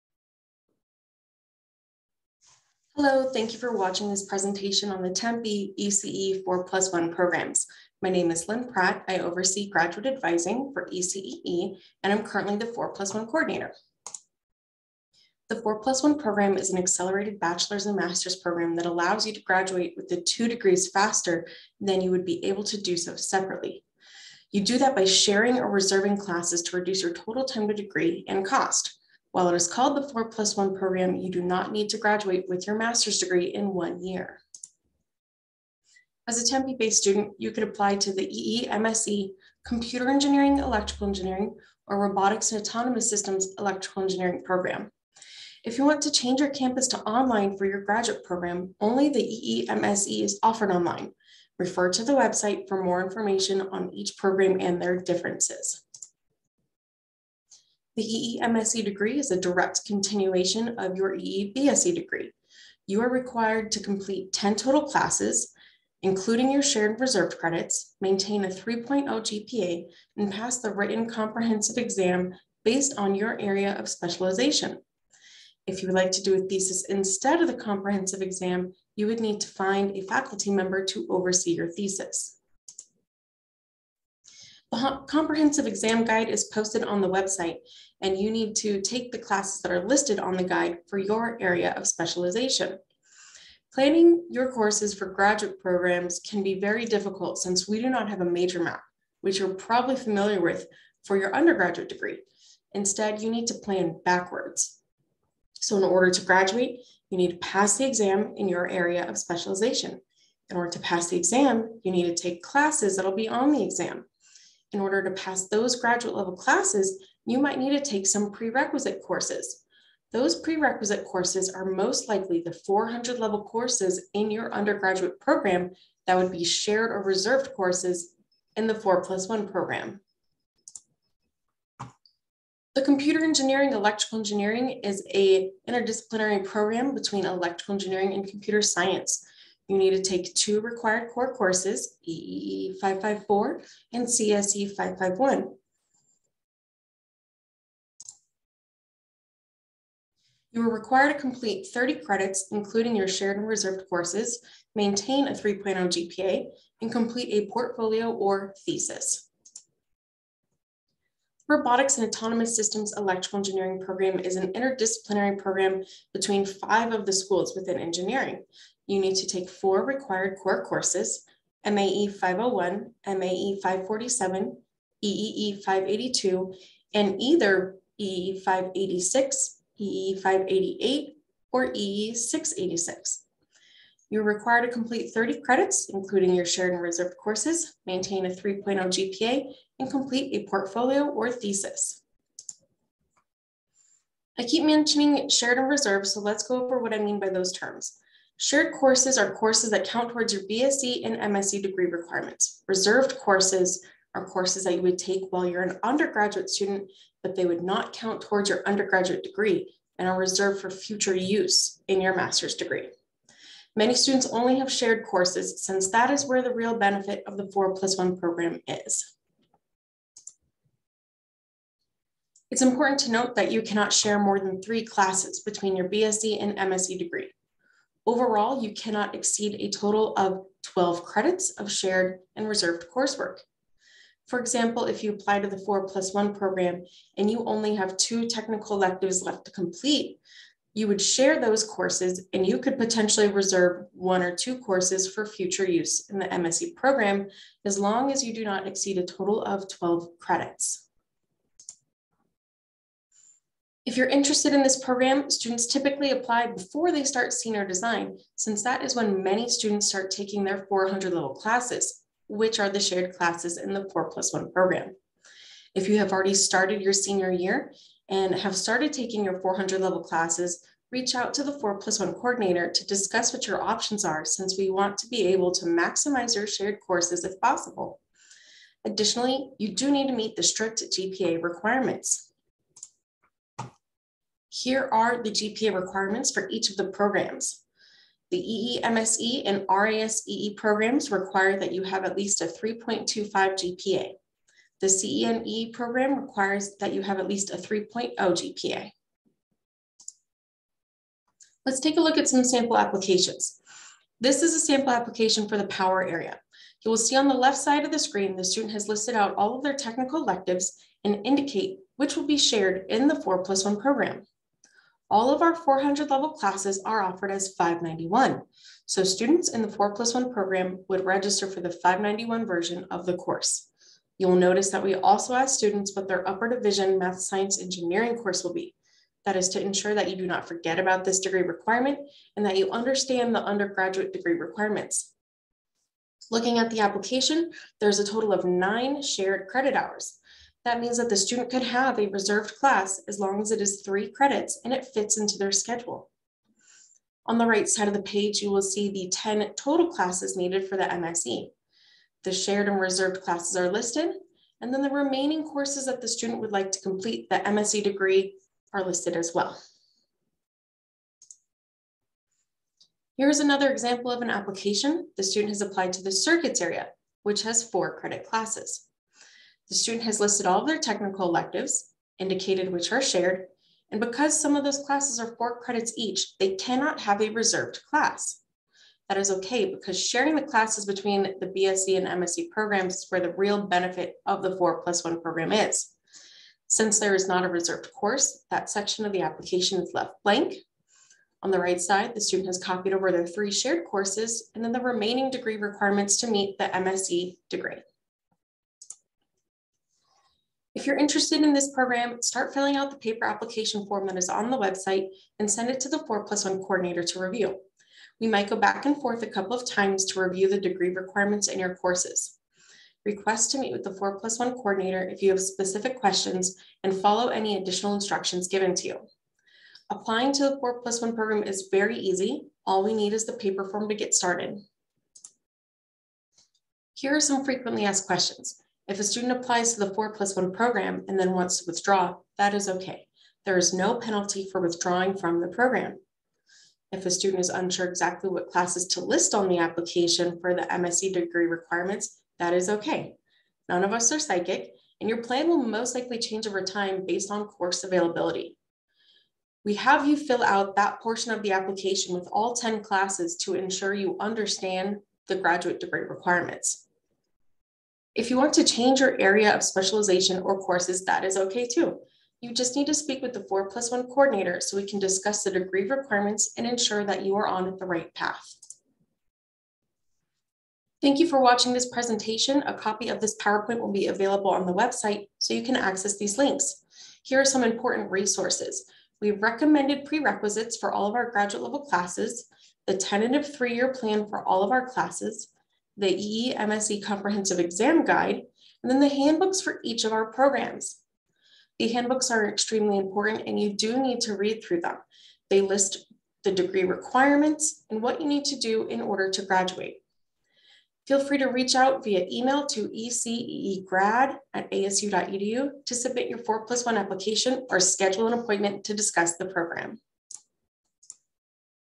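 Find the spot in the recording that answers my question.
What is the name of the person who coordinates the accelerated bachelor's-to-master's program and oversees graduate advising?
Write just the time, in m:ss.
0:08.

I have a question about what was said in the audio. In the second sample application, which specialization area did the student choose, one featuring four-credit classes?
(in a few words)
circuits.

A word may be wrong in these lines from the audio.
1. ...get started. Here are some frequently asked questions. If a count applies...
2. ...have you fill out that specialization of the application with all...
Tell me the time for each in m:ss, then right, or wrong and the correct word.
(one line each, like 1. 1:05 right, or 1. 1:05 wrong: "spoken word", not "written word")
1. 7:03 wrong: "student", not "count"
2. 7:29 wrong: "portion", not "specialization".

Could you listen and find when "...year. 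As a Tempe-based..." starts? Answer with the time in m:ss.
0:34.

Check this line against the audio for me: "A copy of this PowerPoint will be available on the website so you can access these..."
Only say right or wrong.
right.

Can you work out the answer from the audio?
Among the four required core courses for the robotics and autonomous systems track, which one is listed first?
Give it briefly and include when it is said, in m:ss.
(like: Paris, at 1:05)
MAE 501, at 2:51.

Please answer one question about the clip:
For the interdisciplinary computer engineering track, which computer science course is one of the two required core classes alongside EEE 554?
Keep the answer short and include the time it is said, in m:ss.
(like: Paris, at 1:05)
CSE 551, at 2:24.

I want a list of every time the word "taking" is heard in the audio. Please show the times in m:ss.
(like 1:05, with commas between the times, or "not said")
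4:20, 4:28.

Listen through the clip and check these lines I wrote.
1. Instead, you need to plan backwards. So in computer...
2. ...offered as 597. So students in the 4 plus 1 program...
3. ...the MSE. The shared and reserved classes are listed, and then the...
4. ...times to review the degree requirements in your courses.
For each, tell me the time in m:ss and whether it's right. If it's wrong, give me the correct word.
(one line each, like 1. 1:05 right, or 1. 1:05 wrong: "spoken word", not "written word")
1. 1:42 wrong: "order", not "computer"
2. 5:17 wrong: "591", not "597"
3. 5:50 right
4. 6:49 right.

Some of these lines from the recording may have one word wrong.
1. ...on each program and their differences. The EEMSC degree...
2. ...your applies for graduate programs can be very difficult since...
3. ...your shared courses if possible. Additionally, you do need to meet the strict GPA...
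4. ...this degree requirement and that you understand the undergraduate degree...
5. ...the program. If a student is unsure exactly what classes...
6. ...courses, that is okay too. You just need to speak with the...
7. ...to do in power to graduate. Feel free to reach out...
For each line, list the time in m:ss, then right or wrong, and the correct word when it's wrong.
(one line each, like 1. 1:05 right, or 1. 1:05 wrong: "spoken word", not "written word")
1. 0:53 right
2. 1:34 wrong: "courses", not "applies"
3. 4:36 right
4. 5:31 right
5. 7:15 right
6. 7:40 right
7. 8:18 wrong: "order", not "power".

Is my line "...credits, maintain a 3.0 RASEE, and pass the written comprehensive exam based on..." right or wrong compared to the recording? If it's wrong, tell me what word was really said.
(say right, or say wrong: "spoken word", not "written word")
wrong: "GPA", not "RASEE".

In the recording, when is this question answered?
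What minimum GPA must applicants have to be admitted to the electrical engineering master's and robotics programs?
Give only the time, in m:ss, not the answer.
4:52.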